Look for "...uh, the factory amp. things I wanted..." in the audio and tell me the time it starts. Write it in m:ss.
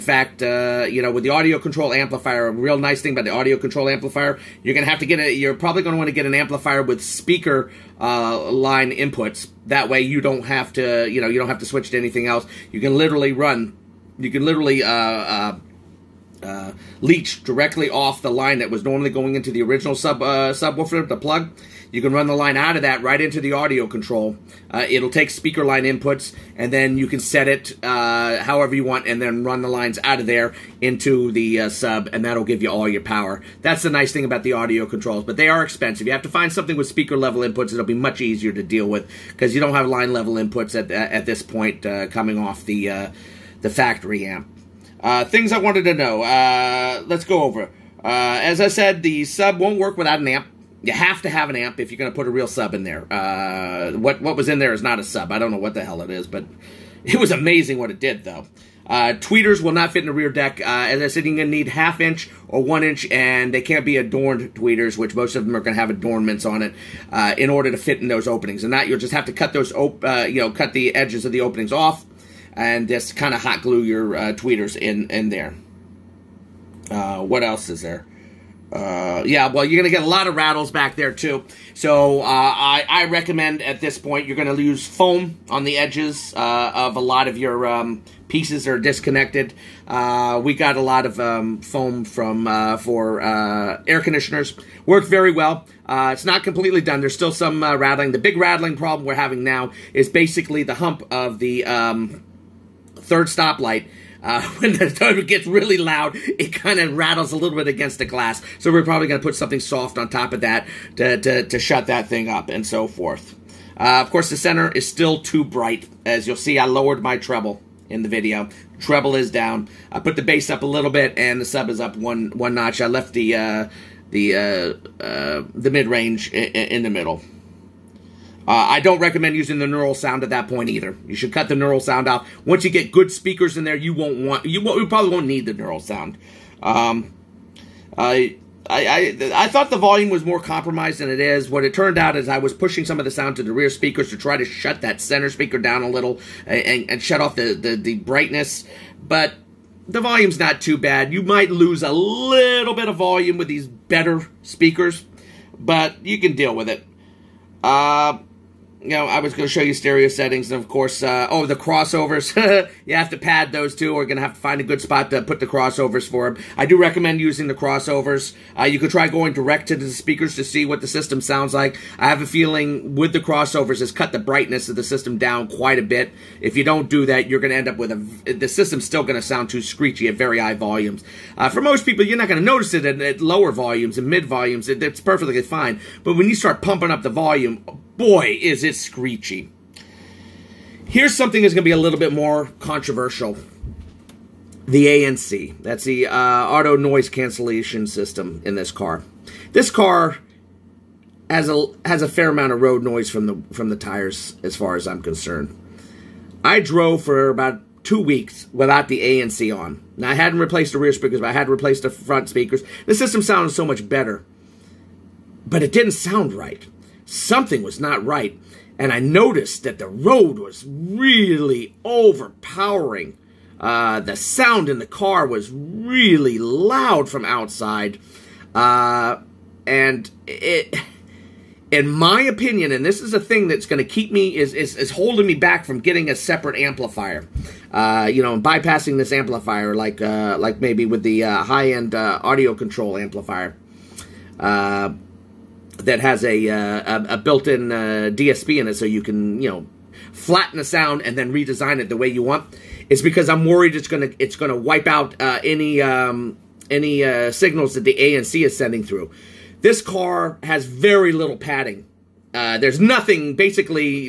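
0:42.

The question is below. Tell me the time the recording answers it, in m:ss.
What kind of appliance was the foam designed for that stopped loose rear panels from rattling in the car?
1:33.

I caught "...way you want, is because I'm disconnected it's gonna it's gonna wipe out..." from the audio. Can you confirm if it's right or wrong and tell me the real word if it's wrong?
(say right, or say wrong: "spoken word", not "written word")
wrong: "worried", not "disconnected".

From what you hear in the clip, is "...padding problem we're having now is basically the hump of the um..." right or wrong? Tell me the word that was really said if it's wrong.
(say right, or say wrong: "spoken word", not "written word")
wrong: "rattling", not "padding".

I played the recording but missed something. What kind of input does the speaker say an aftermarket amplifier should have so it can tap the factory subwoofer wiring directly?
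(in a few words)
speaker line inputs.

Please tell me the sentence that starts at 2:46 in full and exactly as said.
I do recommend using the crossovers.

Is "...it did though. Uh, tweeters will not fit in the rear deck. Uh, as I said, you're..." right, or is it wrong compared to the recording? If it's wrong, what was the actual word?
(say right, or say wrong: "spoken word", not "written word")
right.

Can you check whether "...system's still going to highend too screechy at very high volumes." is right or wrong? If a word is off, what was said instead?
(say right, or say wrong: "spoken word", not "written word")
wrong: "sound", not "highend".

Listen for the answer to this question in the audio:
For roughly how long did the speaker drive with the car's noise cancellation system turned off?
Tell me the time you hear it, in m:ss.
3:27.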